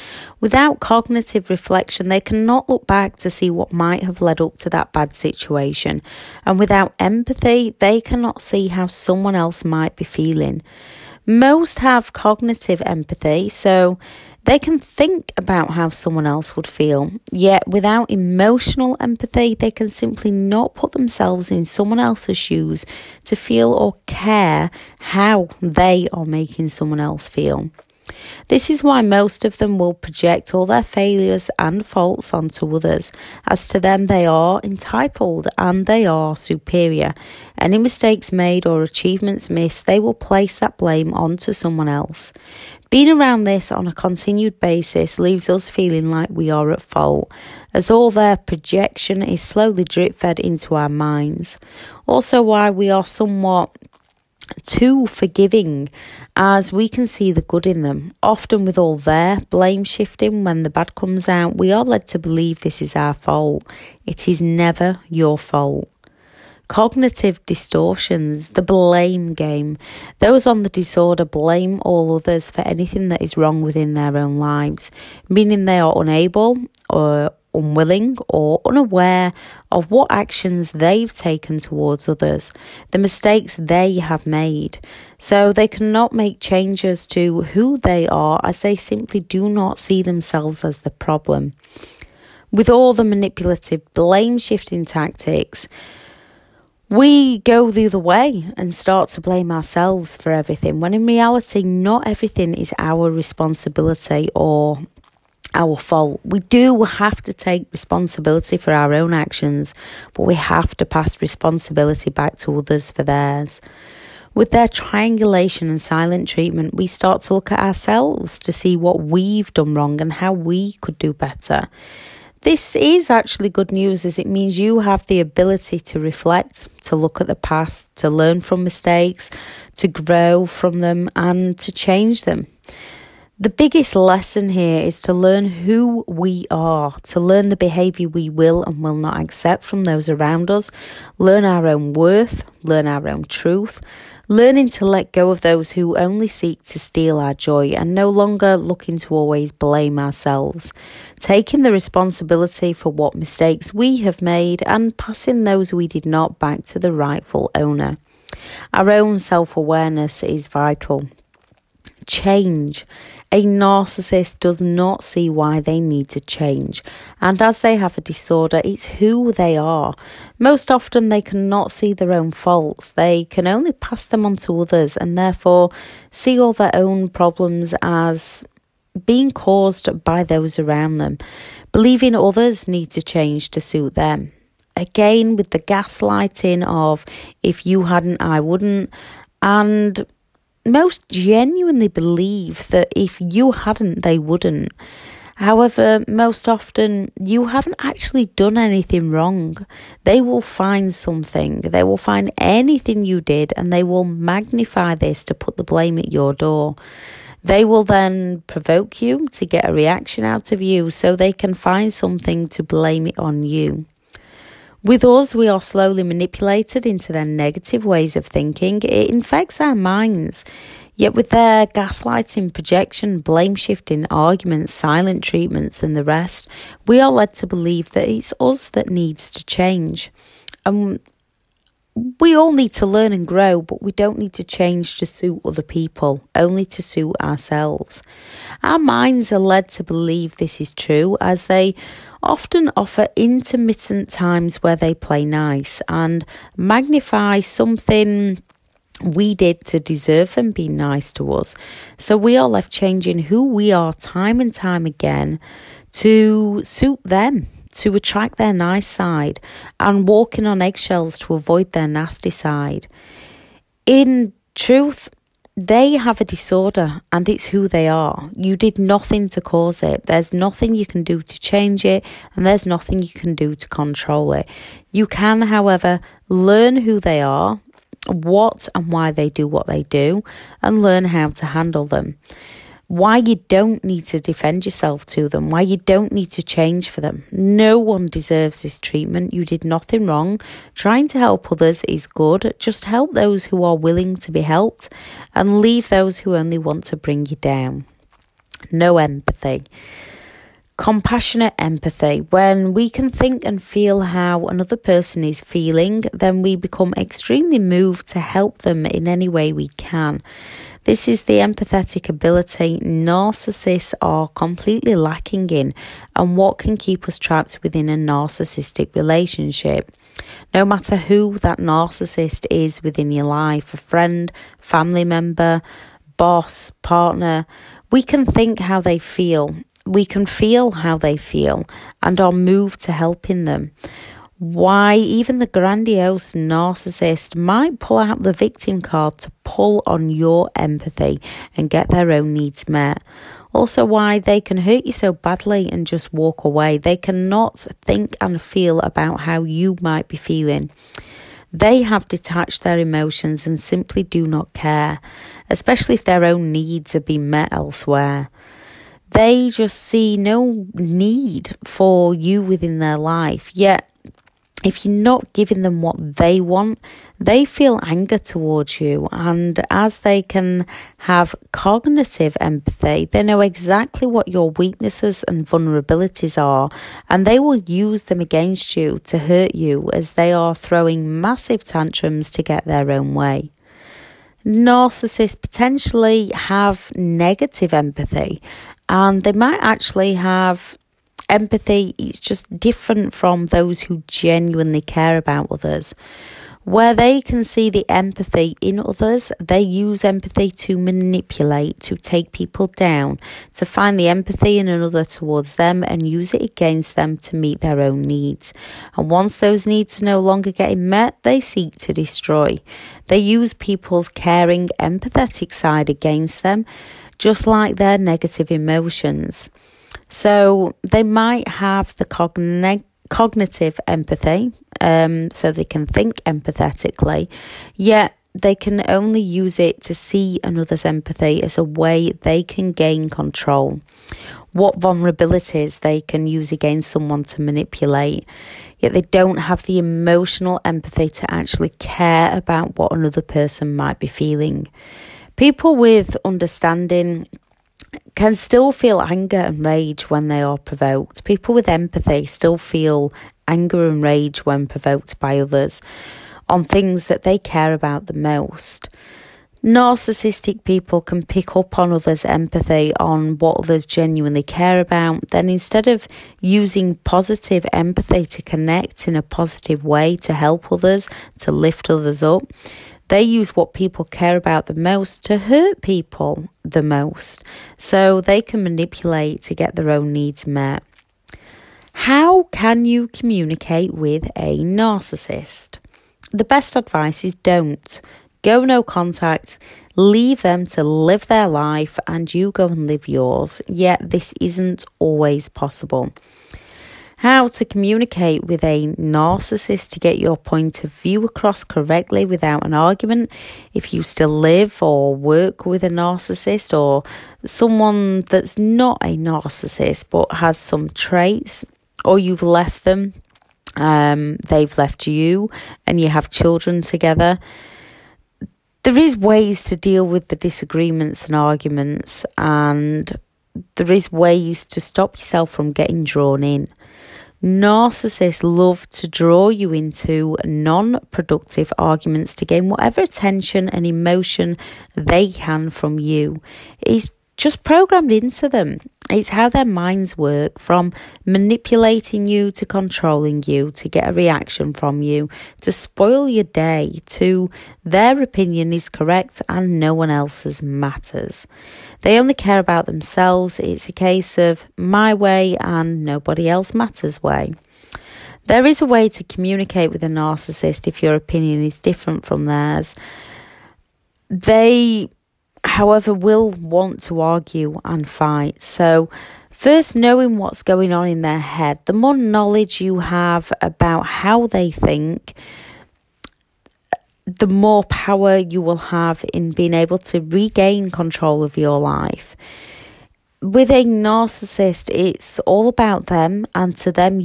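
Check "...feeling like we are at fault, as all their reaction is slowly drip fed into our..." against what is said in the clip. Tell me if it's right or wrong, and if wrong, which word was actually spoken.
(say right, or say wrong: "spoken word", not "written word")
wrong: "projection", not "reaction".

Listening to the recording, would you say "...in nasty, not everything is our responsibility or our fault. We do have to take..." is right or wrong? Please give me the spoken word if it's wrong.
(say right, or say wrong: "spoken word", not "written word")
wrong: "reality", not "nasty".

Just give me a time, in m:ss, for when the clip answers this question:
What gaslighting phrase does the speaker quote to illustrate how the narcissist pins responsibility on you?
3:07.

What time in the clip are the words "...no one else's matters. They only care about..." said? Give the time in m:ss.
9:09.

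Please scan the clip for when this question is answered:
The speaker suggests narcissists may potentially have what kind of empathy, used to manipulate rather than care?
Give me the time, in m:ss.
6:26.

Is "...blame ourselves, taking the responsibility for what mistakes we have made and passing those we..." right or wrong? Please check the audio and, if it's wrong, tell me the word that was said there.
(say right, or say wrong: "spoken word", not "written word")
right.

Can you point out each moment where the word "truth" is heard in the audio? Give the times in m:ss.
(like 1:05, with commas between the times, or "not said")
2:23, 4:24.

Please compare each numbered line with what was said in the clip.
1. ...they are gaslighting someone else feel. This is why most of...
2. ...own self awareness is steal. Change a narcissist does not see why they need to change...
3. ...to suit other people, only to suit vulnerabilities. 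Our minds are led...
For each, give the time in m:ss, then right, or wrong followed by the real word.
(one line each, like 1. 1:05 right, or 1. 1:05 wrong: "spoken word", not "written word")
1. 0:25 wrong: "making", not "gaslighting"
2. 2:38 wrong: "vital", not "steal"
3. 3:54 wrong: "ourselves", not "vulnerabilities".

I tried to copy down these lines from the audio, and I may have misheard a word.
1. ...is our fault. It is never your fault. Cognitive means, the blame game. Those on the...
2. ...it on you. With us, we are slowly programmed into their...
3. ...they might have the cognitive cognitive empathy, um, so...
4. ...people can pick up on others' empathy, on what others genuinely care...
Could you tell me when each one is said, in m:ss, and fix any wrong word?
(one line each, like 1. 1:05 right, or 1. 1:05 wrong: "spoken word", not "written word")
1. 1:02 wrong: "distortions", not "means"
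2. 3:33 wrong: "manipulated", not "programmed"
3. 7:00 right
4. 7:40 right.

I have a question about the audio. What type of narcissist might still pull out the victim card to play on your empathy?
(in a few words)
Grandiose.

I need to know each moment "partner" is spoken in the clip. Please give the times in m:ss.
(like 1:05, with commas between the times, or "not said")
5:26.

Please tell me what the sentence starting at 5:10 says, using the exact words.
This is the empathetic ability narcissists are completely lacking in, and what can keep us trapped within a narcissistic relationship.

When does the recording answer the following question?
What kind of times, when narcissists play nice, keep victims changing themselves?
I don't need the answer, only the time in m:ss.
4:03.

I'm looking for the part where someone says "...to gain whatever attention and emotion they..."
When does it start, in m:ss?
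8:52.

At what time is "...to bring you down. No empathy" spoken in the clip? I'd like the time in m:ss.
4:56.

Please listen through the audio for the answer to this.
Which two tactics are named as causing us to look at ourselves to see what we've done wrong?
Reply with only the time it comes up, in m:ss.
1:54.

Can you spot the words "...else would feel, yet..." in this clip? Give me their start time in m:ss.
0:16.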